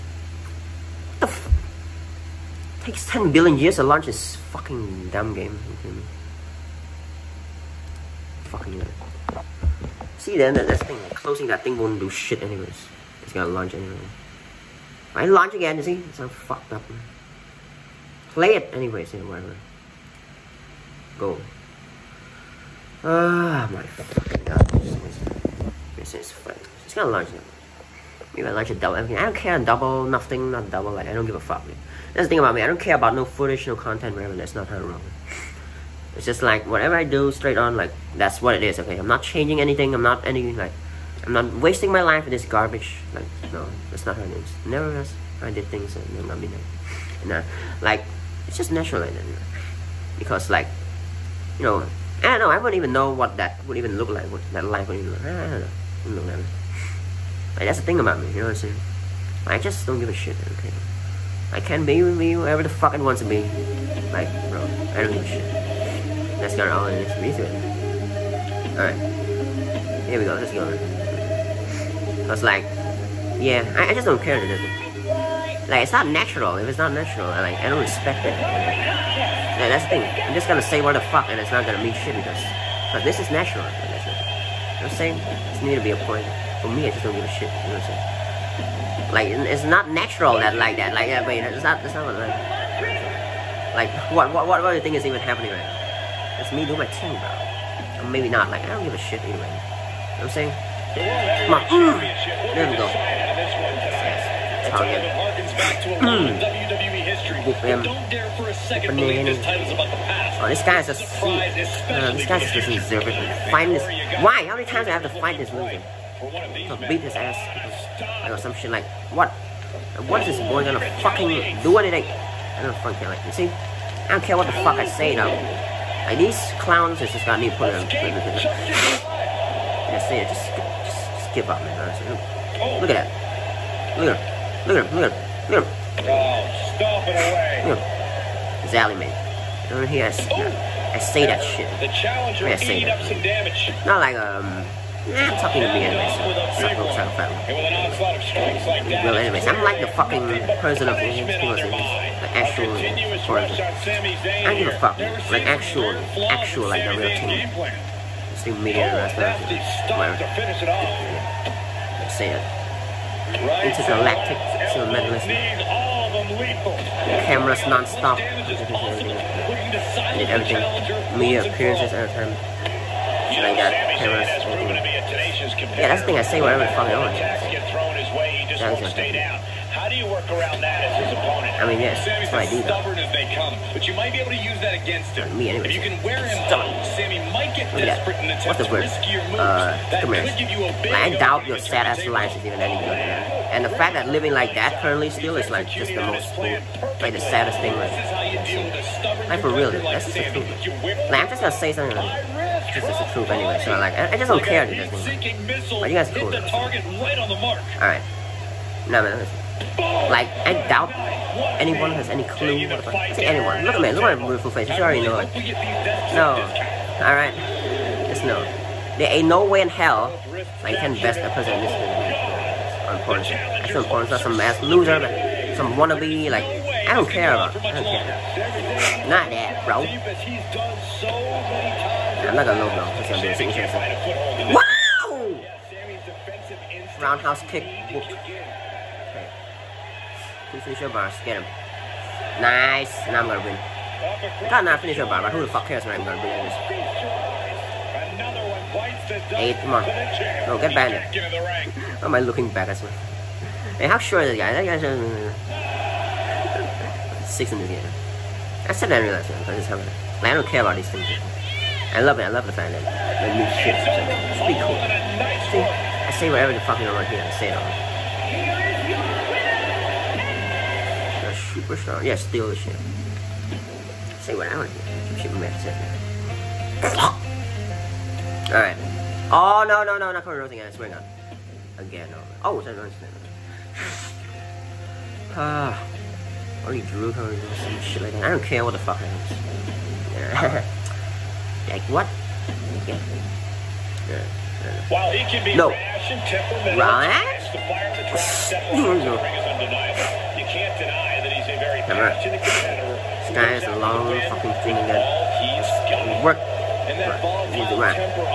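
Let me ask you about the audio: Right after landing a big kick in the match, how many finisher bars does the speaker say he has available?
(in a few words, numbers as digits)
2.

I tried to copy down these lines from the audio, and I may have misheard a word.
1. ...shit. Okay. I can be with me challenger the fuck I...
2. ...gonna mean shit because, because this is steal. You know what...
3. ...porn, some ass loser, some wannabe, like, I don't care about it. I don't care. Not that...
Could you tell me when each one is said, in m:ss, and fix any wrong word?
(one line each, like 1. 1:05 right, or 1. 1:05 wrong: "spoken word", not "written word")
1. 1:00 wrong: "whoever", not "challenger"
2. 1:21 wrong: "natural", not "steal"
3. 3:43 right.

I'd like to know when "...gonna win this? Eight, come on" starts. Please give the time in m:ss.
4:06.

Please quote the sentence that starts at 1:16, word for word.
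If it's not natural, I, like, I don't respect it.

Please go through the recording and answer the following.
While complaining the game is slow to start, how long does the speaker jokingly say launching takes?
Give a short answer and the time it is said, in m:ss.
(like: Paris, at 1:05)
10 billion years, at 0:03.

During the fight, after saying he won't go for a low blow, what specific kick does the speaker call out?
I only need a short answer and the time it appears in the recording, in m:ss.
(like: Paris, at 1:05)
Roundhouse kick, at 3:57.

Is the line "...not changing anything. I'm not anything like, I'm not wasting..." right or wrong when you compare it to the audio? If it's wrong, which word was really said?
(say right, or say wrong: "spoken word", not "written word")
right.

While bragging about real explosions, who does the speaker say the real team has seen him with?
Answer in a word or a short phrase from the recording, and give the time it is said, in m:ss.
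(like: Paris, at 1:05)
Rasmus, at 2:38.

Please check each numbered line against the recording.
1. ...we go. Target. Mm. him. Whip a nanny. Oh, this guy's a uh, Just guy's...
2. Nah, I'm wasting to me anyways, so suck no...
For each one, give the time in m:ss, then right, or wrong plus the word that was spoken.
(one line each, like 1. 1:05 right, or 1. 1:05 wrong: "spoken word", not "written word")
1. 1:42 wrong: "This", not "Just"
2. 2:25 wrong: "talking", not "wasting".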